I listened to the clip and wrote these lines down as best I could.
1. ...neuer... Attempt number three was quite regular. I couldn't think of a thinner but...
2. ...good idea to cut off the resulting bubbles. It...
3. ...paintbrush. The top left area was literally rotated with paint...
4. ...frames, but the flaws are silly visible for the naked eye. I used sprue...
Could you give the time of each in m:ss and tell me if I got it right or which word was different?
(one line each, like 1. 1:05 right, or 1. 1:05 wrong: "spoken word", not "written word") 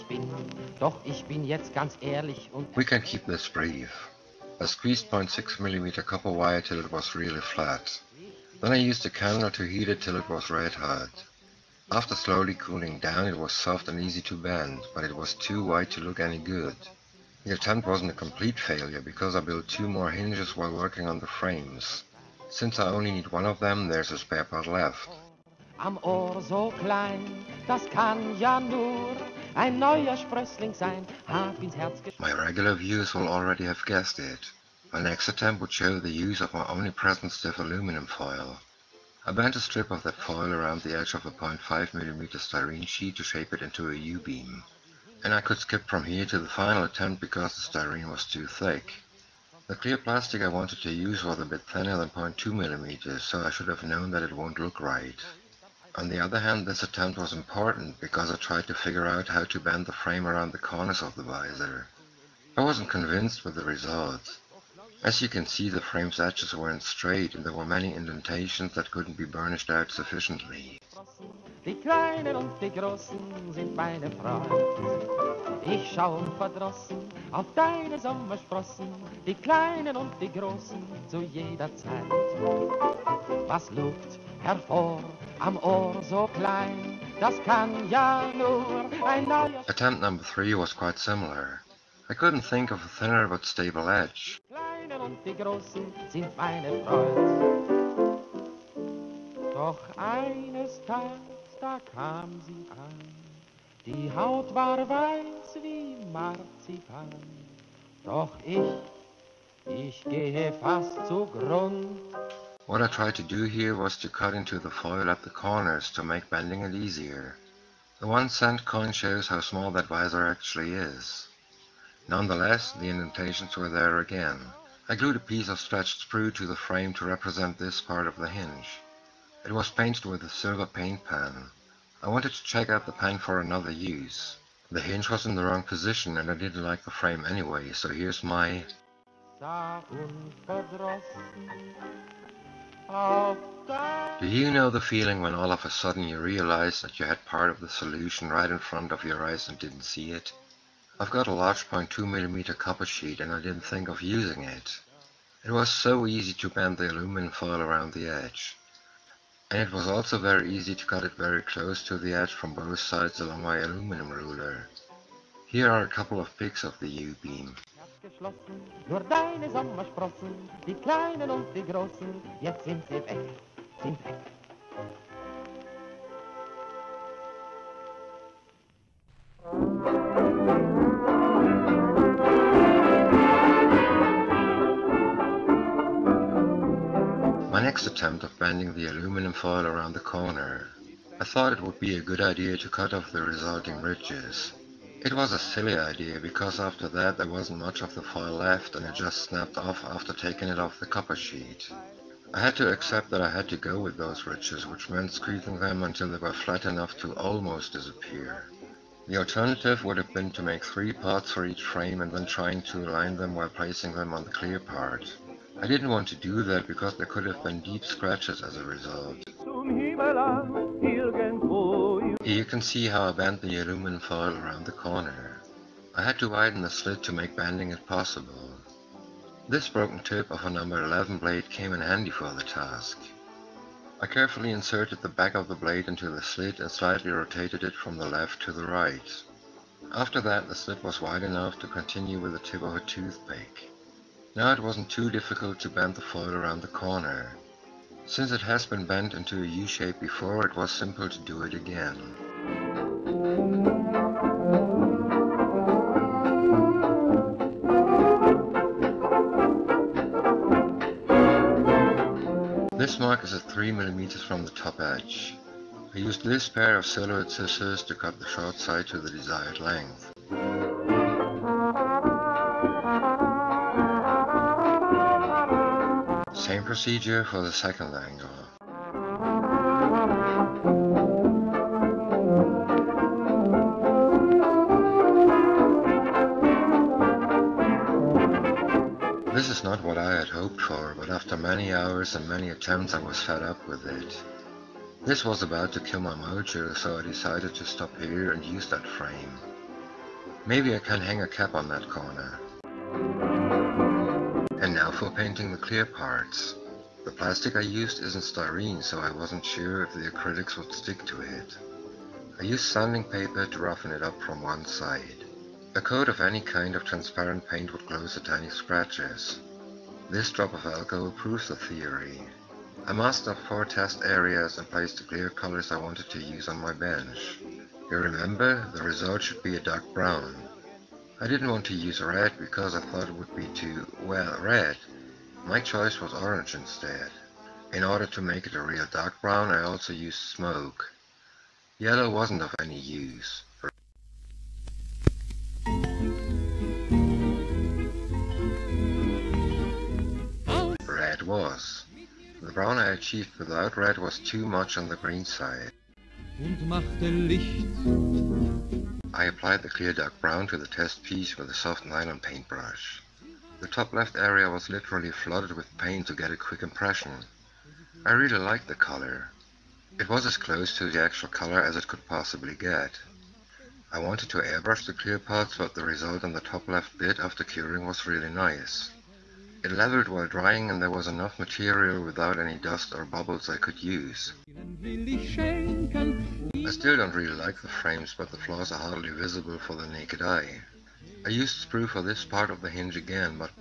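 1. 1:29 wrong: "similar", not "regular"
2. 3:12 wrong: "ridges", not "bubbles"
3. 6:02 wrong: "flooded", not "rotated"
4. 6:27 wrong: "hardly", not "silly".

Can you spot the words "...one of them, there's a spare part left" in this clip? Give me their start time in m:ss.
0:23.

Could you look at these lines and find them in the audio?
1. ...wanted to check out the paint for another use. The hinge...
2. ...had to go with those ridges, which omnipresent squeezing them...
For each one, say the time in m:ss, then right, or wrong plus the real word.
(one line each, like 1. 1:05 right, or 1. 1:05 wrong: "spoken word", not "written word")
1. 2:12 right
2. 3:23 wrong: "meant", not "omnipresent".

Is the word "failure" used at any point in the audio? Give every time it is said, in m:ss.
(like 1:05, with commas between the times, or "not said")
0:18.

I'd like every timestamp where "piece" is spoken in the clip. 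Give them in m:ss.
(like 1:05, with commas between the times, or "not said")
2:05, 6:01.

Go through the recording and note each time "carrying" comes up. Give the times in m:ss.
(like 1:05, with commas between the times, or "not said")
not said.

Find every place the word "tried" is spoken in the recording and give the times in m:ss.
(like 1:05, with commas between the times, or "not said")
0:58, 1:52.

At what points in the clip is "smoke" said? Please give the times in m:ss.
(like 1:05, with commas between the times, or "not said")
5:40.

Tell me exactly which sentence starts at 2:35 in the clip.
It was so easy to bend the aluminum foil around the edge.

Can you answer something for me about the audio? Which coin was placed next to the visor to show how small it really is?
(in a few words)
one cent coin.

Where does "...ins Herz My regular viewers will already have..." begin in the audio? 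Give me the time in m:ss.
0:31.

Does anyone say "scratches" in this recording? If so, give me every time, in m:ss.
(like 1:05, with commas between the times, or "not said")
3:37, 5:18.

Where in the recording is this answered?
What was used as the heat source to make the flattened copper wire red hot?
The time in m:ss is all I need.
0:09.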